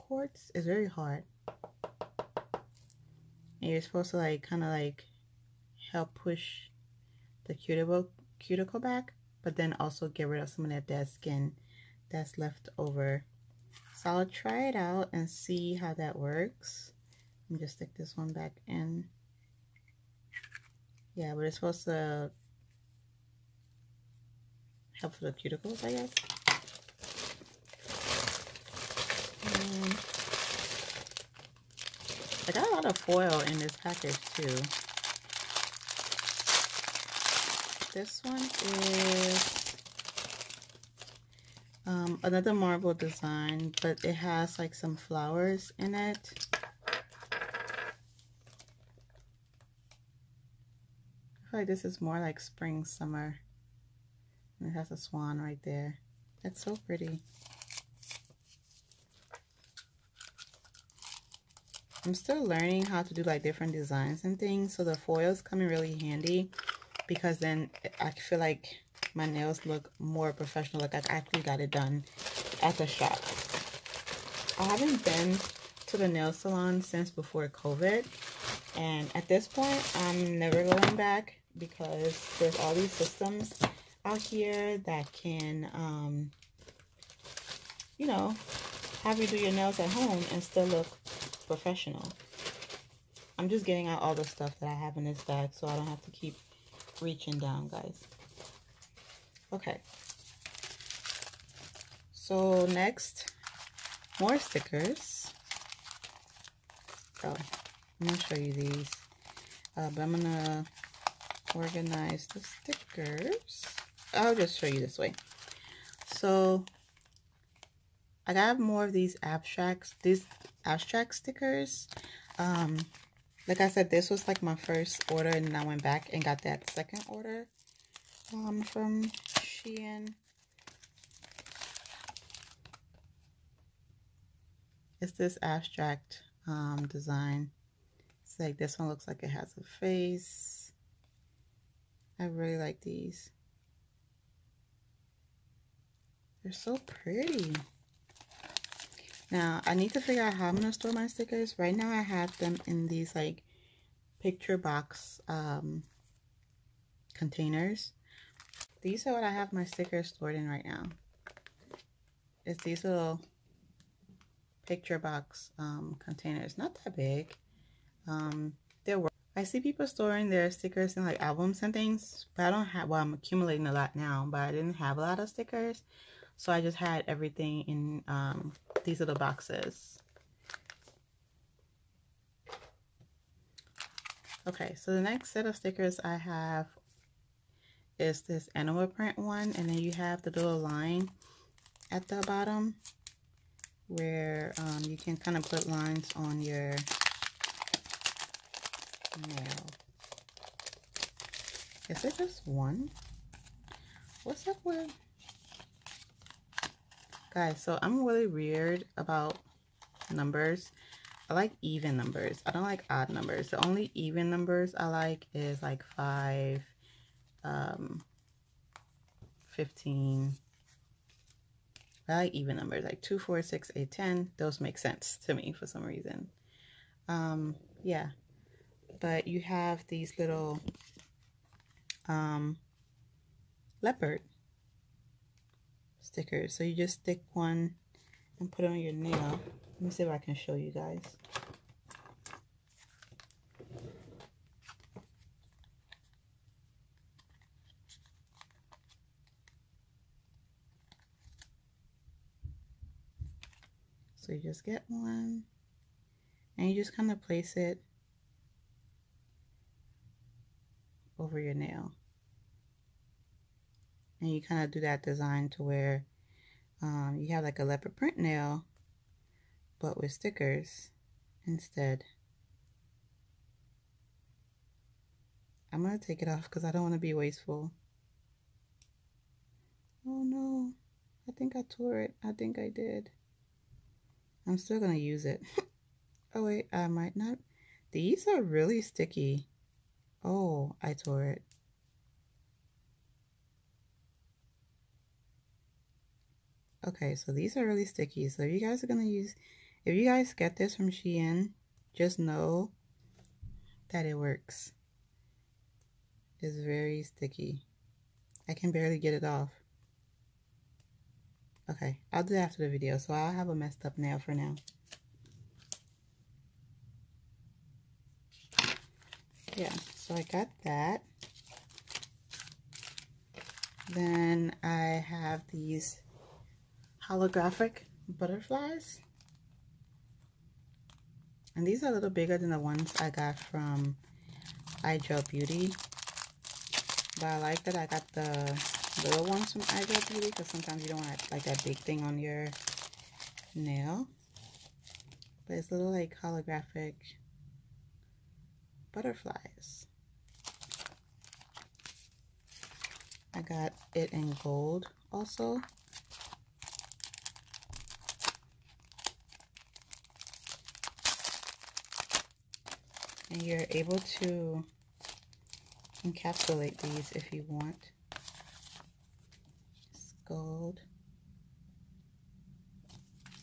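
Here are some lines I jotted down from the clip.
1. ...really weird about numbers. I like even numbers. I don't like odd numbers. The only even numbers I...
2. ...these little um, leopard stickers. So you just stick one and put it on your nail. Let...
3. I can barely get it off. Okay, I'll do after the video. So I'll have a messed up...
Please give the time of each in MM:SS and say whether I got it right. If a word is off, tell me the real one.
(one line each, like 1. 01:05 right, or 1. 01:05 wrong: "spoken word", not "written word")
1. 03:28 right
2. 03:49 right
3. 05:08 right.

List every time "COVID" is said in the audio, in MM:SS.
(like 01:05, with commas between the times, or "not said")
01:17.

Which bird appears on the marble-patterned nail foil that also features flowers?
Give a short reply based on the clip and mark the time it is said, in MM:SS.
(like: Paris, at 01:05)
Swan, at 00:54.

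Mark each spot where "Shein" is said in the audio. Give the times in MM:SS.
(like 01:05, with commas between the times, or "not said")
02:09, 05:00.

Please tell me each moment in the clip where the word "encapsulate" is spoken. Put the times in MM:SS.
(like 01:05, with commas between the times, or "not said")
06:06.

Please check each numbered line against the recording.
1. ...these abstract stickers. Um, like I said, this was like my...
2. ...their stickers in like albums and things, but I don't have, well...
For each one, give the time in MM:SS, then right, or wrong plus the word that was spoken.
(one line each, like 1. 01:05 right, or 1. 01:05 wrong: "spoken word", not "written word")
1. 02:00 right
2. 02:50 right.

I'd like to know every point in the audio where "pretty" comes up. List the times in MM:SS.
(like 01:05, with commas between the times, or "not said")
00:56, 02:27.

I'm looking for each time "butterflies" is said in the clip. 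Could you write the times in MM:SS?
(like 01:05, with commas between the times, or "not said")
05:28, 05:48.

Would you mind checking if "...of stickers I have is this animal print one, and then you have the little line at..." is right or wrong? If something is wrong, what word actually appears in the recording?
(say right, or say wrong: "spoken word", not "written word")
right.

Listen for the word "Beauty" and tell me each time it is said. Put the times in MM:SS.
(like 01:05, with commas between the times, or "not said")
05:35, 05:40.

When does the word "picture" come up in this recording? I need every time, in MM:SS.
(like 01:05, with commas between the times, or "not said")
02:34, 02:44.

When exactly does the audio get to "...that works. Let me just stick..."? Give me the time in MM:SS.
00:15.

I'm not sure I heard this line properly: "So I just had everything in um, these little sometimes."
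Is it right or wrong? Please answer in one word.
wrong.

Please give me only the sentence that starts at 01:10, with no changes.
Like I actually got it done at the shop.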